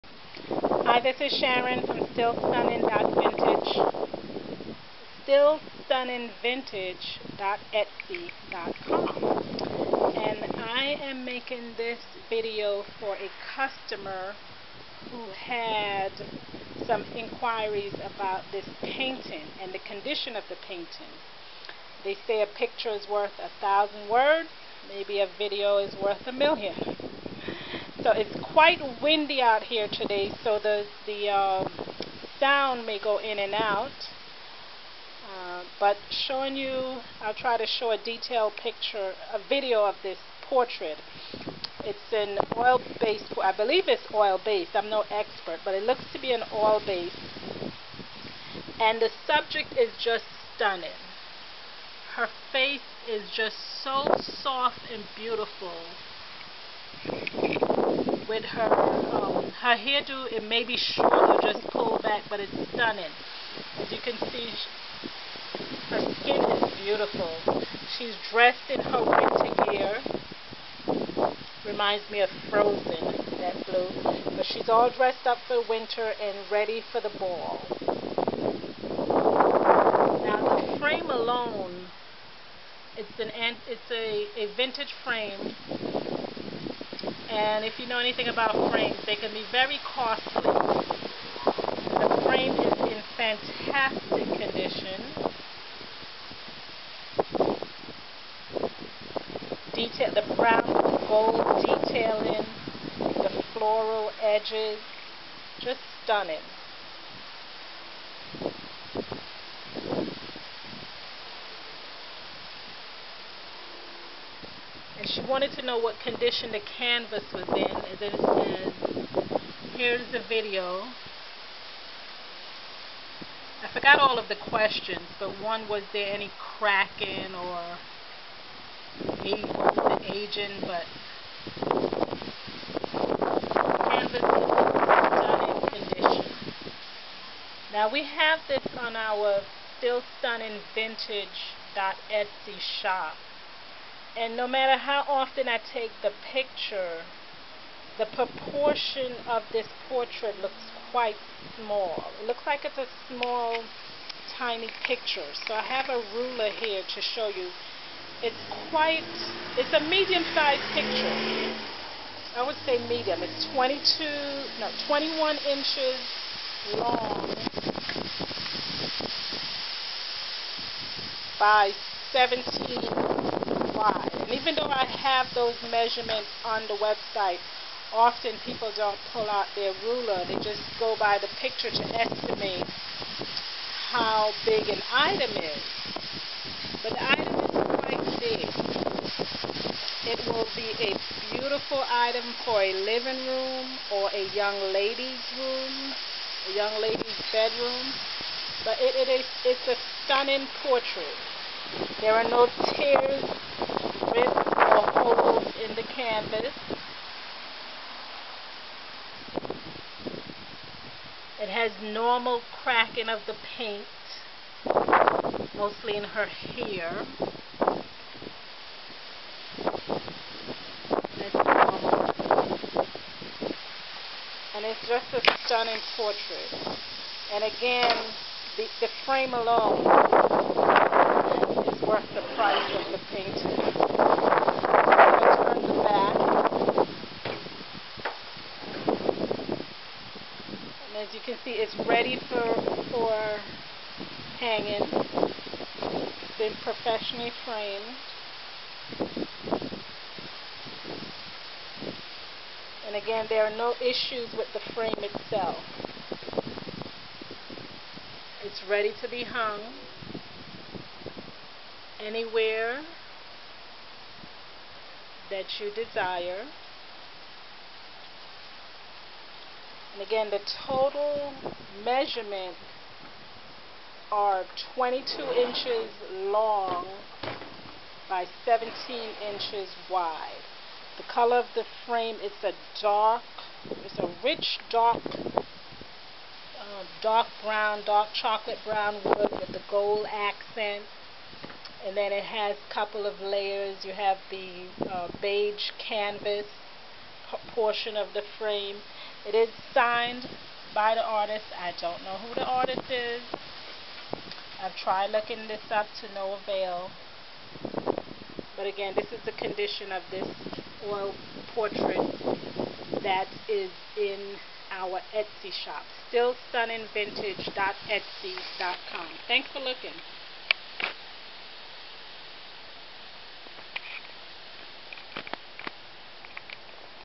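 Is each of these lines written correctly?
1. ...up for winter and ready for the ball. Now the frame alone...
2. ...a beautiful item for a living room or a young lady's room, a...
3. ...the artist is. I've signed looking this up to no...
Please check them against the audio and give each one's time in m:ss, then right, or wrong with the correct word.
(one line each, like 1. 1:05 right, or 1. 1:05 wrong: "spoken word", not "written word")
1. 1:15 right
2. 3:10 right
3. 5:02 wrong: "tried", not "signed".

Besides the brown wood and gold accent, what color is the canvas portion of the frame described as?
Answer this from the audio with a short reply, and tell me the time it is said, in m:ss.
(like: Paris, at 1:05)
Beige, at 4:55.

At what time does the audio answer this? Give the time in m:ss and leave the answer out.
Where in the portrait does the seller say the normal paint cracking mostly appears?
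3:35.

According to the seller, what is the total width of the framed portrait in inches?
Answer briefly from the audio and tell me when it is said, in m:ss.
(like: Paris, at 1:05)
17, at 4:38.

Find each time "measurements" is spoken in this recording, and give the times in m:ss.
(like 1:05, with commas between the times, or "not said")
2:55, 4:31.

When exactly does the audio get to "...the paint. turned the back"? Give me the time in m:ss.
3:52.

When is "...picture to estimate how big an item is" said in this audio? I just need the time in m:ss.
3:01.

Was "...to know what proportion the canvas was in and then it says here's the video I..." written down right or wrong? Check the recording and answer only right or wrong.
wrong.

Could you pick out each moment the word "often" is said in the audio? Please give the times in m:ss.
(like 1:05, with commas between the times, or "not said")
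2:25, 2:57.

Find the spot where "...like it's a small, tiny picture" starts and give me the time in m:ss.
2:32.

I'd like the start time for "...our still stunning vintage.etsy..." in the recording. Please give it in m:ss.
2:18.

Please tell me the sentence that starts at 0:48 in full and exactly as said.
And the subject is just stunning.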